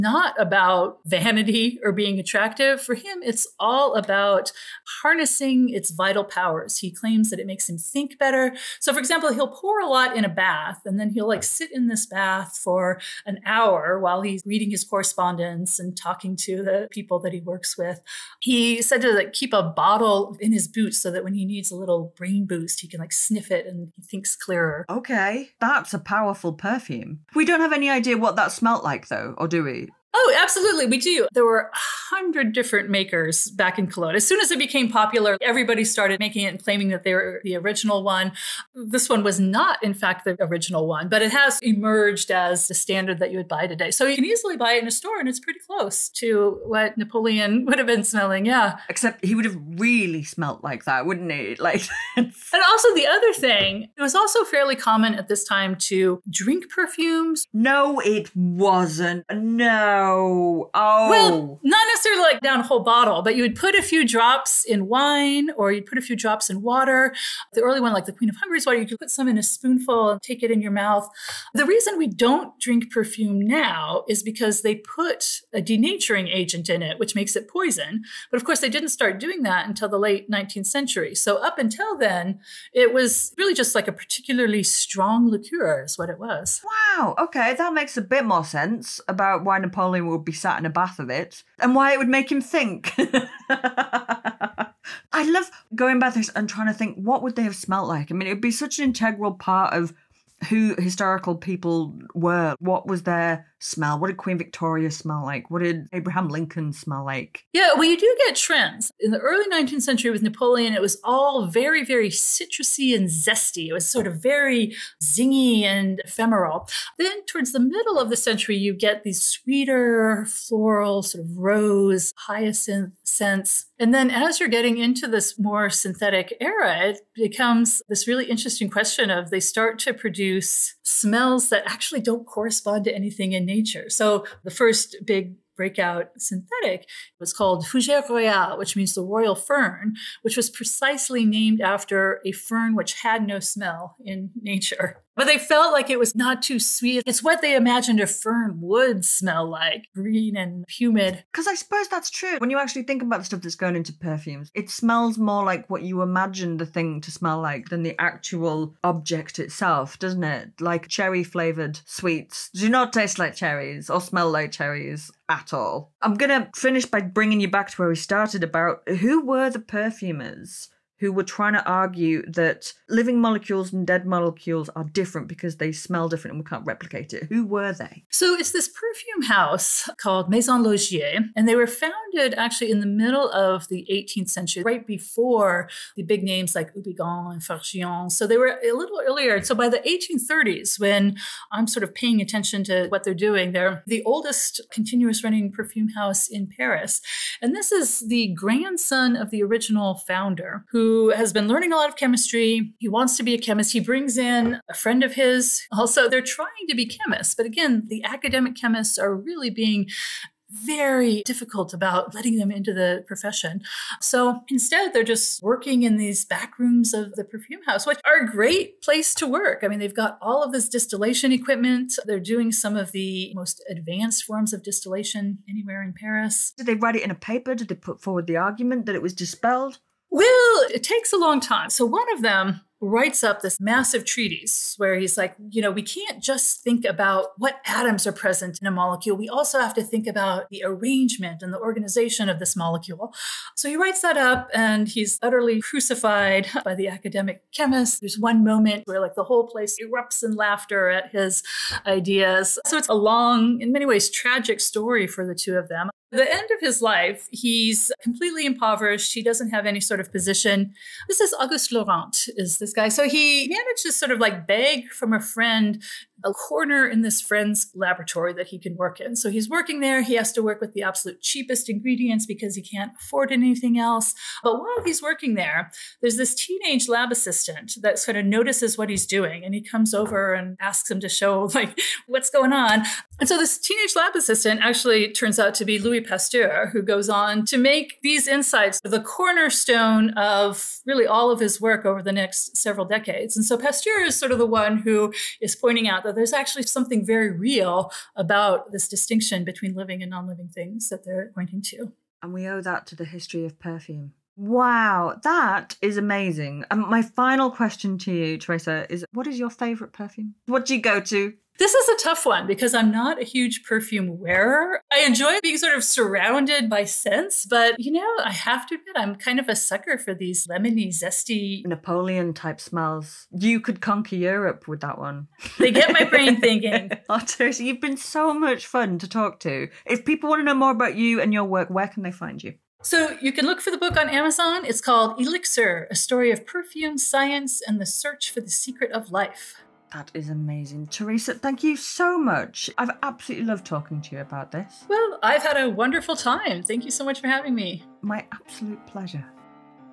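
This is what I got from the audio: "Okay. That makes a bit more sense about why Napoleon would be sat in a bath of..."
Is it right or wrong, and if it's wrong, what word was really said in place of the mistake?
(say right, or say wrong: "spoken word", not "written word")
right.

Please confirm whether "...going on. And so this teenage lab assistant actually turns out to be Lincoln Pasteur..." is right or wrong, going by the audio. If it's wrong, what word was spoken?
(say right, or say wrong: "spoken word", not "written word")
wrong: "Louis", not "Lincoln".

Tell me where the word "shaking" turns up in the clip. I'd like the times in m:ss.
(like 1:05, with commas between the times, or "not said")
not said.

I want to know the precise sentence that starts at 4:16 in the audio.
the end of his life, he's completely impoverished.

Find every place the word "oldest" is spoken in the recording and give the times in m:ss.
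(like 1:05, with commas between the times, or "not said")
3:14.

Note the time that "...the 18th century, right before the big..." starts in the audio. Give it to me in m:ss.
3:03.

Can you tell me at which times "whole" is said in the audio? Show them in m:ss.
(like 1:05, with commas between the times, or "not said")
1:02, 4:09.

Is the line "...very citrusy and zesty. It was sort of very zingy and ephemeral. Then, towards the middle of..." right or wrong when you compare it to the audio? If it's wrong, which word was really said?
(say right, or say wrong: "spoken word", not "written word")
right.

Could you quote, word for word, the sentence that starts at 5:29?
If people want to know more about you and your work, where can they find you?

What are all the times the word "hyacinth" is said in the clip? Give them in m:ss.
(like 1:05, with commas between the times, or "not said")
2:02.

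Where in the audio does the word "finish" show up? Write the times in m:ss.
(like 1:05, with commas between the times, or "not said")
2:46.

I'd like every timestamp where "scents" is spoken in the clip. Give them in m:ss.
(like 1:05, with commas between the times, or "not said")
2:03, 5:16.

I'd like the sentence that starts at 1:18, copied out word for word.
But of course, they didn't start doing that until the late 19th century.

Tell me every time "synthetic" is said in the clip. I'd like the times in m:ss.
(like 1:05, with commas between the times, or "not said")
2:05, 2:16.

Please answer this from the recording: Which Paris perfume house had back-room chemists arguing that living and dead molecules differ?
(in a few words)
Maison Laugier.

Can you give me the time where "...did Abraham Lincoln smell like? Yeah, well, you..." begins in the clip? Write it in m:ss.
1:45.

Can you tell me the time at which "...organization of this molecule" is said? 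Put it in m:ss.
4:01.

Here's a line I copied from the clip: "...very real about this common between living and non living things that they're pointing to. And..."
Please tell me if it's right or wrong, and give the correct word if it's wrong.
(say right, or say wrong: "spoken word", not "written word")
wrong: "distinction", not "common".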